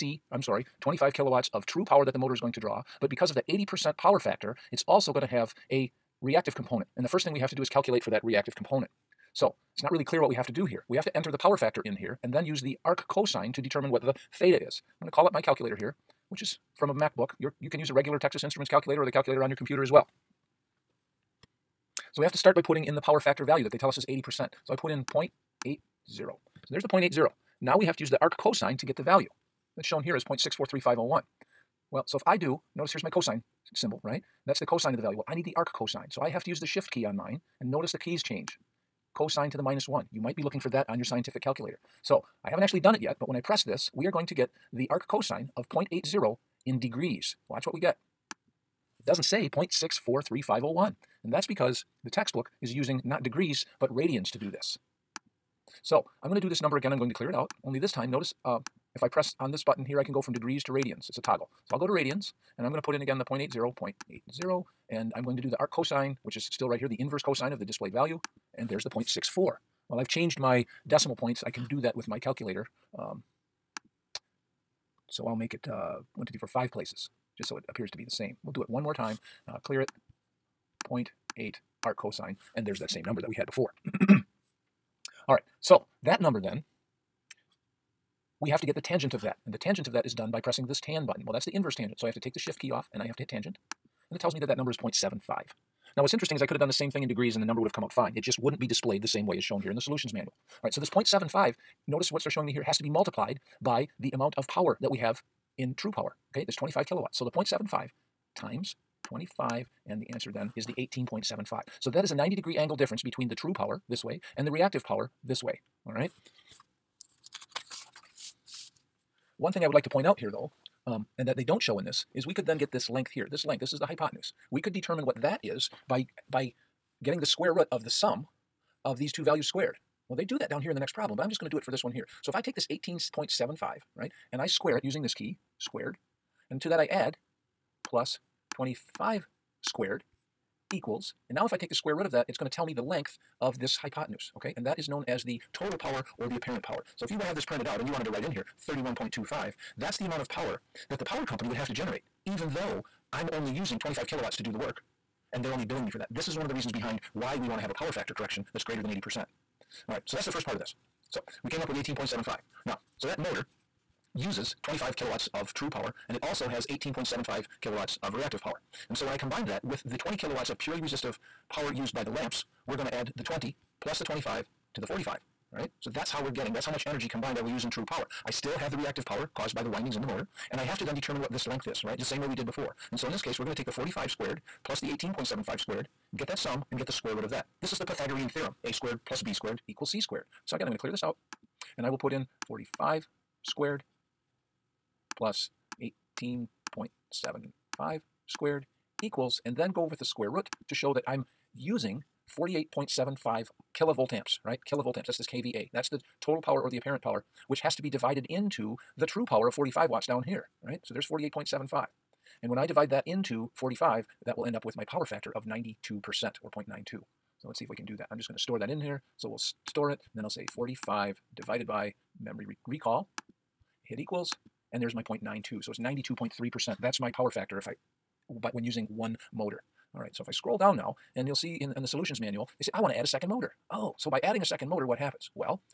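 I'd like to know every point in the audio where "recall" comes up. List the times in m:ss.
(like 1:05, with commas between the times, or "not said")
3:42.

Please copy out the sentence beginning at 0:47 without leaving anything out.
Watch what we get doesn't say 0.643501.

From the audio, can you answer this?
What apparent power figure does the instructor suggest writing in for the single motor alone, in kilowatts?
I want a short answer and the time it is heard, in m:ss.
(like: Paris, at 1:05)
31.25, at 2:28.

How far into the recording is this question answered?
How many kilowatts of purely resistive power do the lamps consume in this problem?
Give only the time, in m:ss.
2:49.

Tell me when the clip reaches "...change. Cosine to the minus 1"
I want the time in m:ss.
0:38.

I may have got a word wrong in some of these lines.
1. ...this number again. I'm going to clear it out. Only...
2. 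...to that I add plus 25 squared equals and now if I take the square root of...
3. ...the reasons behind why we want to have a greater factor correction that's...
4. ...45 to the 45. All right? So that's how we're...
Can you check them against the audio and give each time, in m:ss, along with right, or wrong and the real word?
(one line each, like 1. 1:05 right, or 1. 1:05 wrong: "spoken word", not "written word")
1. 0:56 right
2. 2:16 right
3. 2:36 wrong: "power", not "greater"
4. 2:54 wrong: "25", not "45".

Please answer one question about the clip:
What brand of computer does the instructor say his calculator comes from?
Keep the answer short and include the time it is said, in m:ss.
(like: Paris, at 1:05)
MacBook, at 0:16.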